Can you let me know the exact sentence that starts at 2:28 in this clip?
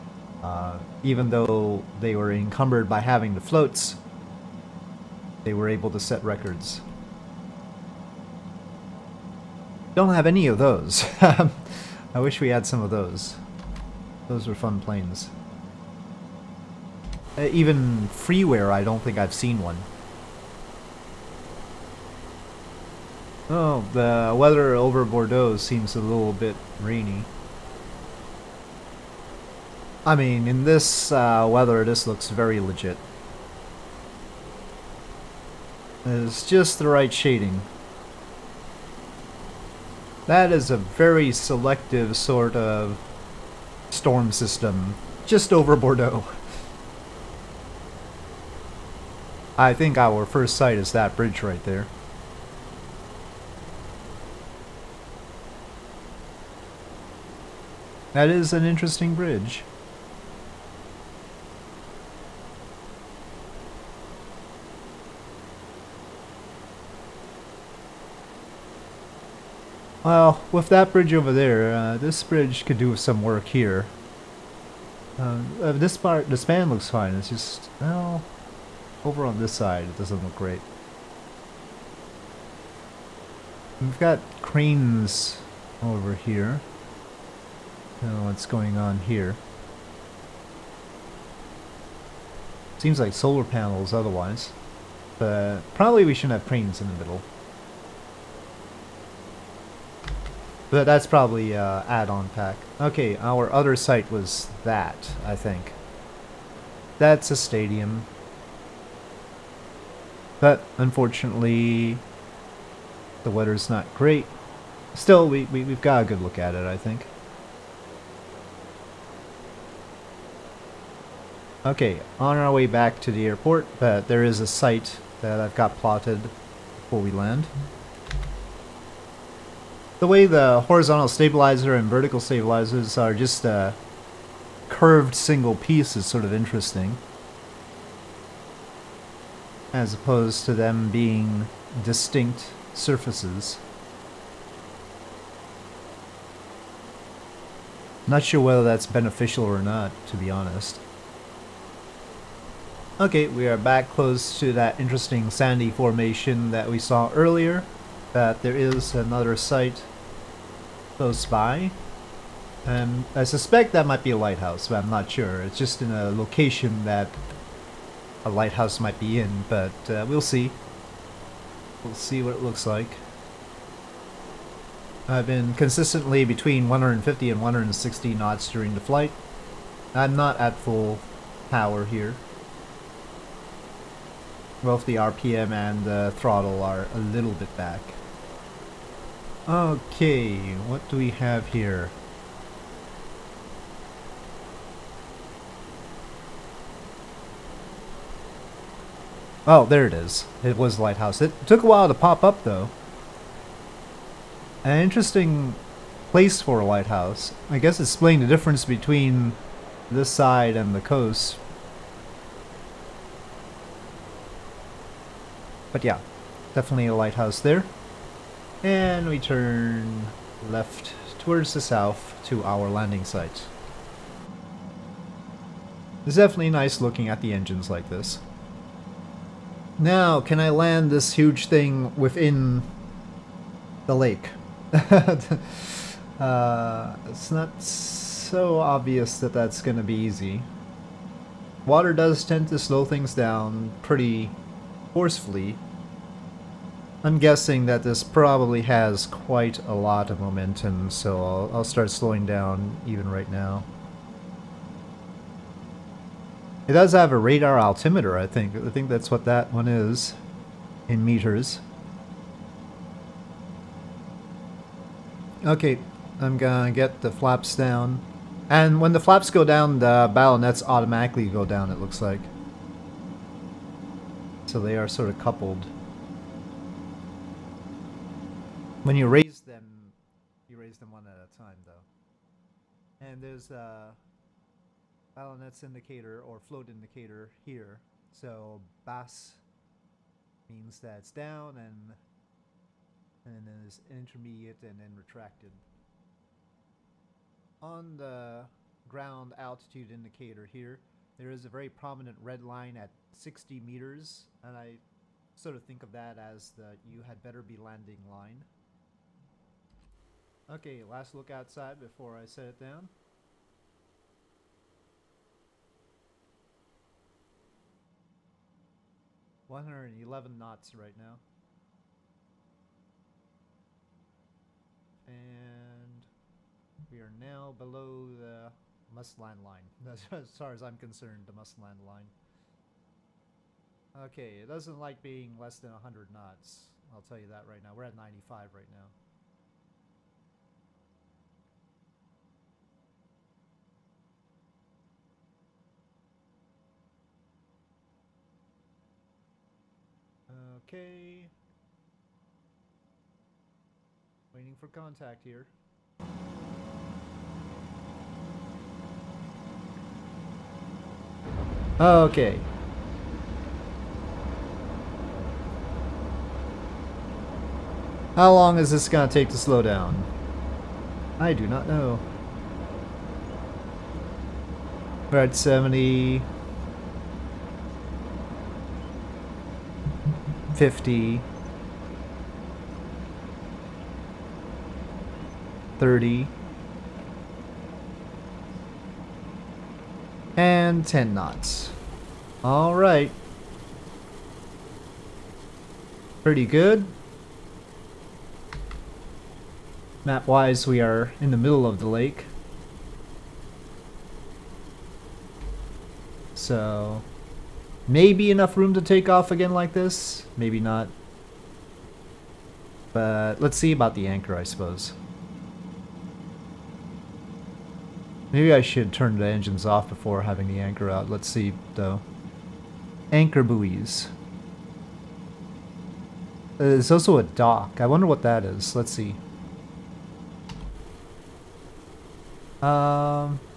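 Not sure whether that's beneficial or not, to be honest.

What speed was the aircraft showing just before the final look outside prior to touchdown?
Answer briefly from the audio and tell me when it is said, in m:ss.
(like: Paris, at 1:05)
111 knots, at 5:19.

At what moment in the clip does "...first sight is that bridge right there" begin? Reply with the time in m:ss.
0:50.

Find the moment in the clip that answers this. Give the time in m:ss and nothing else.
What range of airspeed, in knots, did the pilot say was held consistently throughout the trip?
2:56.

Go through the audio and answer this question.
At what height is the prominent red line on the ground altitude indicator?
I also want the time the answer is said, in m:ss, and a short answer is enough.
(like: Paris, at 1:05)
60 meters, at 5:03.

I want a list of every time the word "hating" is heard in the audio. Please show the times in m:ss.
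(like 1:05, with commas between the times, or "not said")
not said.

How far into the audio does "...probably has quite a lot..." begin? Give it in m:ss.
4:08.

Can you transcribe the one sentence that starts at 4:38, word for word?
When you raise them, you raise them one at a time, though.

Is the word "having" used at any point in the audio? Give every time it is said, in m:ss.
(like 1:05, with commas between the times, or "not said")
0:02, 7:00.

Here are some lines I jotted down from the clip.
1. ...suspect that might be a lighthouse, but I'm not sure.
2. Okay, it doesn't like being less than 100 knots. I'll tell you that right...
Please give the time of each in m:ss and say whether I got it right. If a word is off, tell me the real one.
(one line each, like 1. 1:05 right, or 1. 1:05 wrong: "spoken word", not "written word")
1. 2:43 right
2. 5:33 right.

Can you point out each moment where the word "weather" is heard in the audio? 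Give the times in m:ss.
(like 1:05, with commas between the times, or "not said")
0:24, 0:31, 1:53.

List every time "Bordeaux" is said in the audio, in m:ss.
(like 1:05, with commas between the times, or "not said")
0:25, 0:45.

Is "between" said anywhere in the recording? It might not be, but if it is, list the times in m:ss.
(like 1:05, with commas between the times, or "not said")
2:56, 3:28.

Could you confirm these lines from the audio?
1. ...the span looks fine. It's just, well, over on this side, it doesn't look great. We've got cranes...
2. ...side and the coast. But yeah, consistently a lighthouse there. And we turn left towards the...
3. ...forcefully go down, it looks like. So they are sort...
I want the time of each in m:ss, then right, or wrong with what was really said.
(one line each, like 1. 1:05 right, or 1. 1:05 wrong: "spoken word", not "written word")
1. 1:16 right
2. 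3:30 wrong: "definitely", not "consistently"
3. 4:30 wrong: "automatically", not "forcefully".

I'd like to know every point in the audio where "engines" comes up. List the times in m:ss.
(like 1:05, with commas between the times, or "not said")
3:47, 6:59.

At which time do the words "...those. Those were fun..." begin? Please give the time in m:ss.
0:12.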